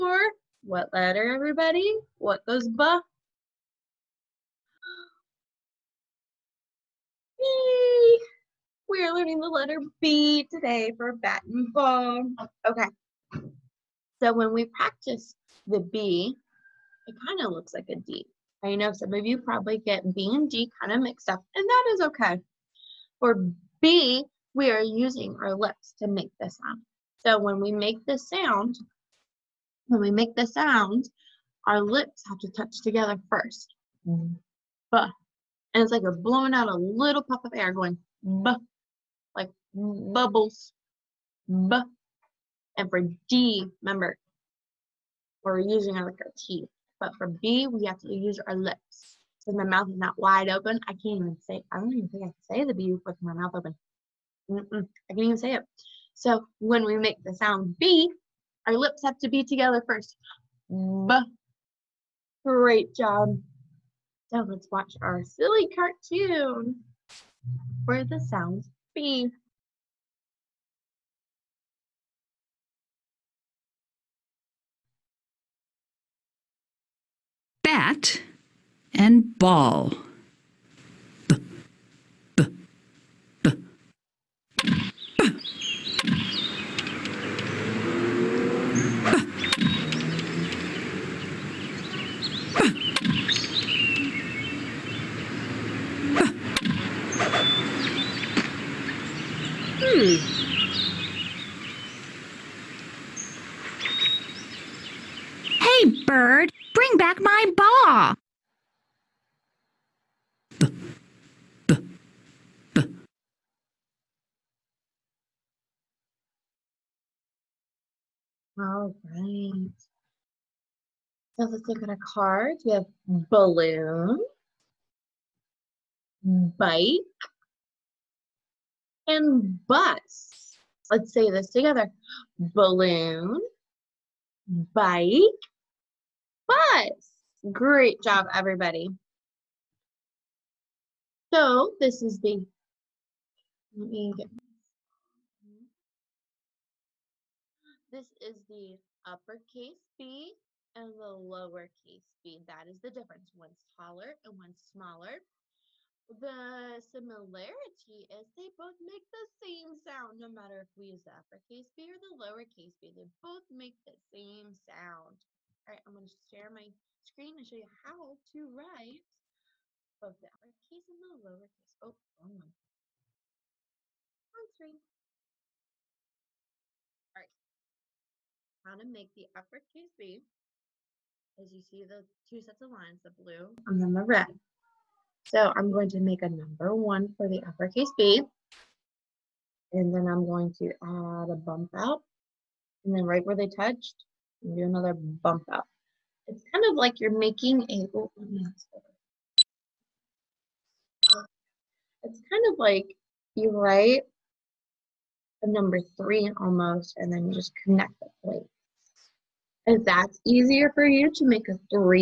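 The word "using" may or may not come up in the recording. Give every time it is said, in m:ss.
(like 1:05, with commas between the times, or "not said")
0:24, 0:45.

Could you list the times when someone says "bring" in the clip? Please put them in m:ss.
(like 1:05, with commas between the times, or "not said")
1:46.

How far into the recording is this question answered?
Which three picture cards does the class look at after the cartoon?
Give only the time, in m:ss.
2:03.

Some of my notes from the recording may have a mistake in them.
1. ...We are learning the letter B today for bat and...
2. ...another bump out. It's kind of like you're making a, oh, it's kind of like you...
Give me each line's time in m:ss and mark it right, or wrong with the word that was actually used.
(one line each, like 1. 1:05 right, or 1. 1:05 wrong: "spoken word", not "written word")
1. 0:08 right
2. 3:14 right.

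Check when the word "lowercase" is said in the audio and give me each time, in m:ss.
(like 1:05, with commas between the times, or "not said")
2:31, 2:42, 2:51.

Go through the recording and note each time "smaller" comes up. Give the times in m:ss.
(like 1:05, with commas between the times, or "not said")
2:34.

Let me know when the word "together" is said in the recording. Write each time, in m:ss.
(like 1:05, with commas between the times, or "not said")
0:32, 0:59, 2:11.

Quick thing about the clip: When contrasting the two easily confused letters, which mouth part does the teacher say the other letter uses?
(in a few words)
teeth.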